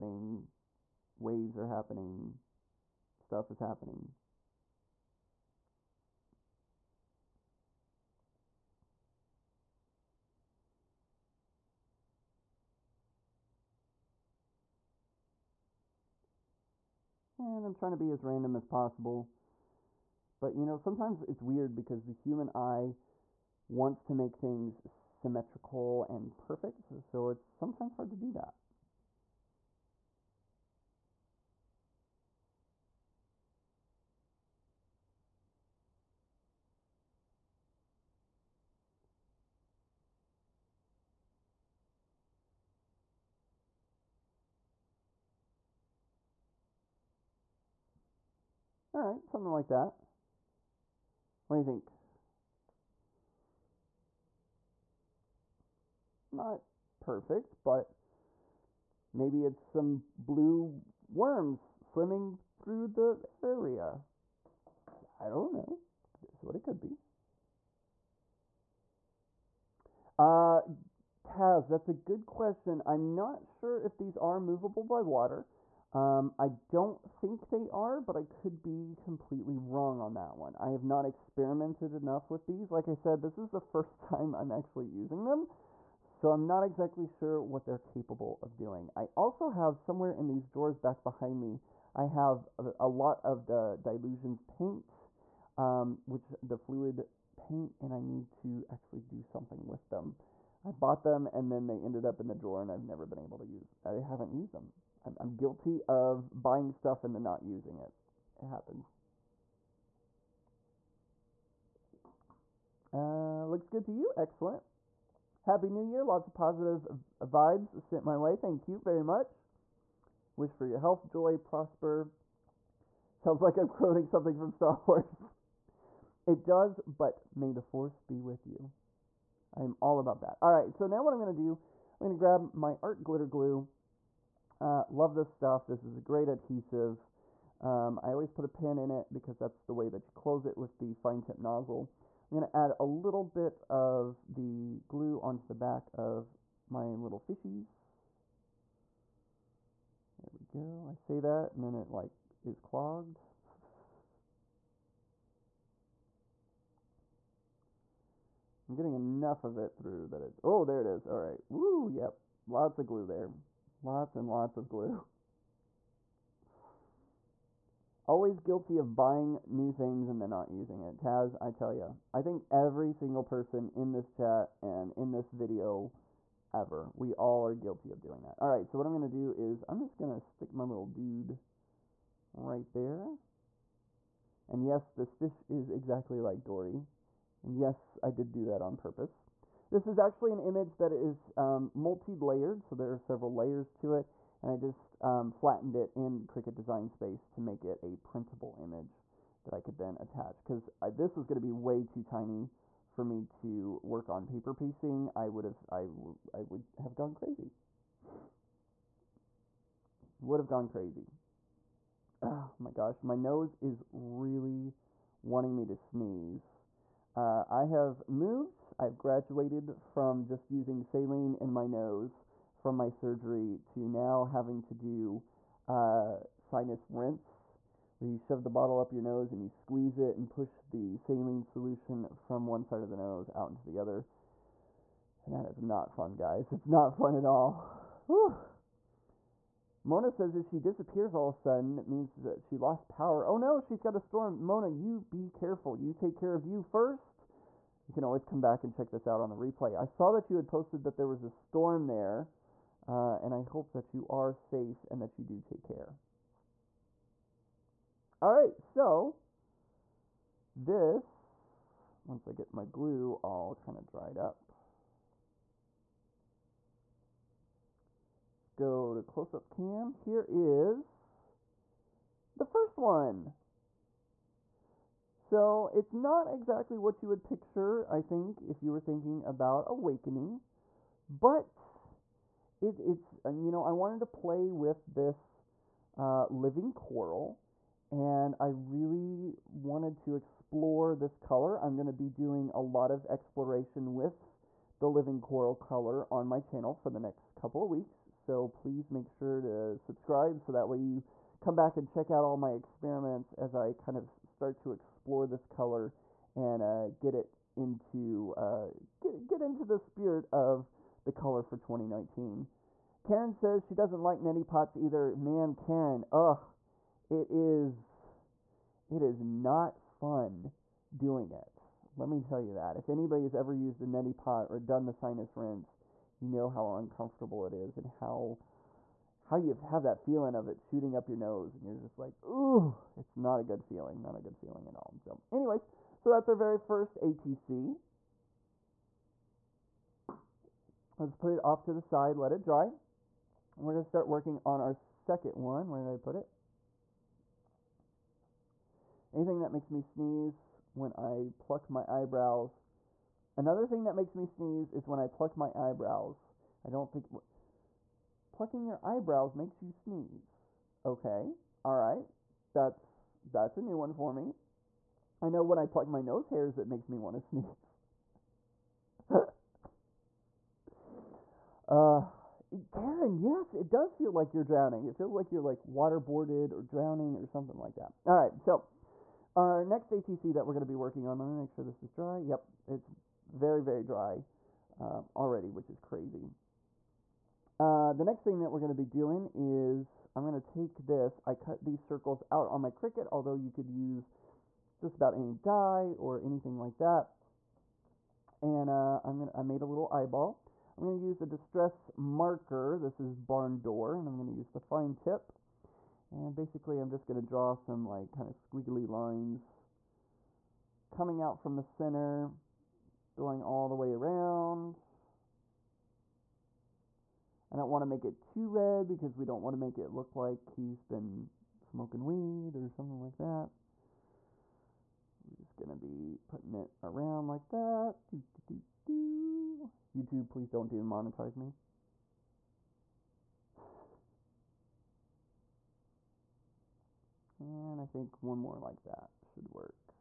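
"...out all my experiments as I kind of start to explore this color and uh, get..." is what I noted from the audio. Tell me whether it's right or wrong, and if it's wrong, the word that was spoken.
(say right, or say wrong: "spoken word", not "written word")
right.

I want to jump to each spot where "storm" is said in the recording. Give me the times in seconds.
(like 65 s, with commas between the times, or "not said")
243 s, 251 s.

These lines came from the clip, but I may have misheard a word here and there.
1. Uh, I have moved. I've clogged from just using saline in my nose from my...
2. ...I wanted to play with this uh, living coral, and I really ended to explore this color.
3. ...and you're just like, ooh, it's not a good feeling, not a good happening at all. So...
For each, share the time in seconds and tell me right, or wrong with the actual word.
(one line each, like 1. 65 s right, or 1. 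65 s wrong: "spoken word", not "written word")
1. 217 s wrong: "graduated", not "clogged"
2. 283 s wrong: "wanted", not "ended"
3. 331 s wrong: "feeling", not "happening".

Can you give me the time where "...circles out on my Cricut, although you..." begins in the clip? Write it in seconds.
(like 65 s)
391 s.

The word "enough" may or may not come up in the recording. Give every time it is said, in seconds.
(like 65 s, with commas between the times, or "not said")
81 s, 158 s.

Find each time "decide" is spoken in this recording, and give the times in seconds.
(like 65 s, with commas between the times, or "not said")
not said.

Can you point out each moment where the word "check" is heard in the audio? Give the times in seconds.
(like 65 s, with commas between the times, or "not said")
248 s, 301 s.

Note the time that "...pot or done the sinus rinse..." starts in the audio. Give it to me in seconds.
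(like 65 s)
324 s.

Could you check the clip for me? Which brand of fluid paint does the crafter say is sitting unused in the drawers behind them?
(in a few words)
Dylusions.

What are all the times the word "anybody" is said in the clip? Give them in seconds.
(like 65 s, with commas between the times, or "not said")
322 s.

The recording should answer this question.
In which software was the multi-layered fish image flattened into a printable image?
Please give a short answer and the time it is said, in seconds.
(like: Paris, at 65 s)
Cricut Design Space, at 196 s.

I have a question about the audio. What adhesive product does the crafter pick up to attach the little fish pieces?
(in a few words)
art glitter glue.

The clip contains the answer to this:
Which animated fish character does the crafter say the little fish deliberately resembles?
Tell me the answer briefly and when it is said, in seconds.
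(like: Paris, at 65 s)
Dory, at 186 s.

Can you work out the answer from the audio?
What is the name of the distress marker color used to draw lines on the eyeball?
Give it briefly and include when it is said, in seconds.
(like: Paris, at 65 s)
barn door, at 403 s.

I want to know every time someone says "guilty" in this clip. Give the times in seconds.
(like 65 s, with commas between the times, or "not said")
105 s, 168 s, 177 s.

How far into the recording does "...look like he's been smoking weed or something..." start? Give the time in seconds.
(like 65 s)
419 s.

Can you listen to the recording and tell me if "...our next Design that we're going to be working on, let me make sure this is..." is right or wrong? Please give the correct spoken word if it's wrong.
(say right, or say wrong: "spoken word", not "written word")
wrong: "ATC", not "Design".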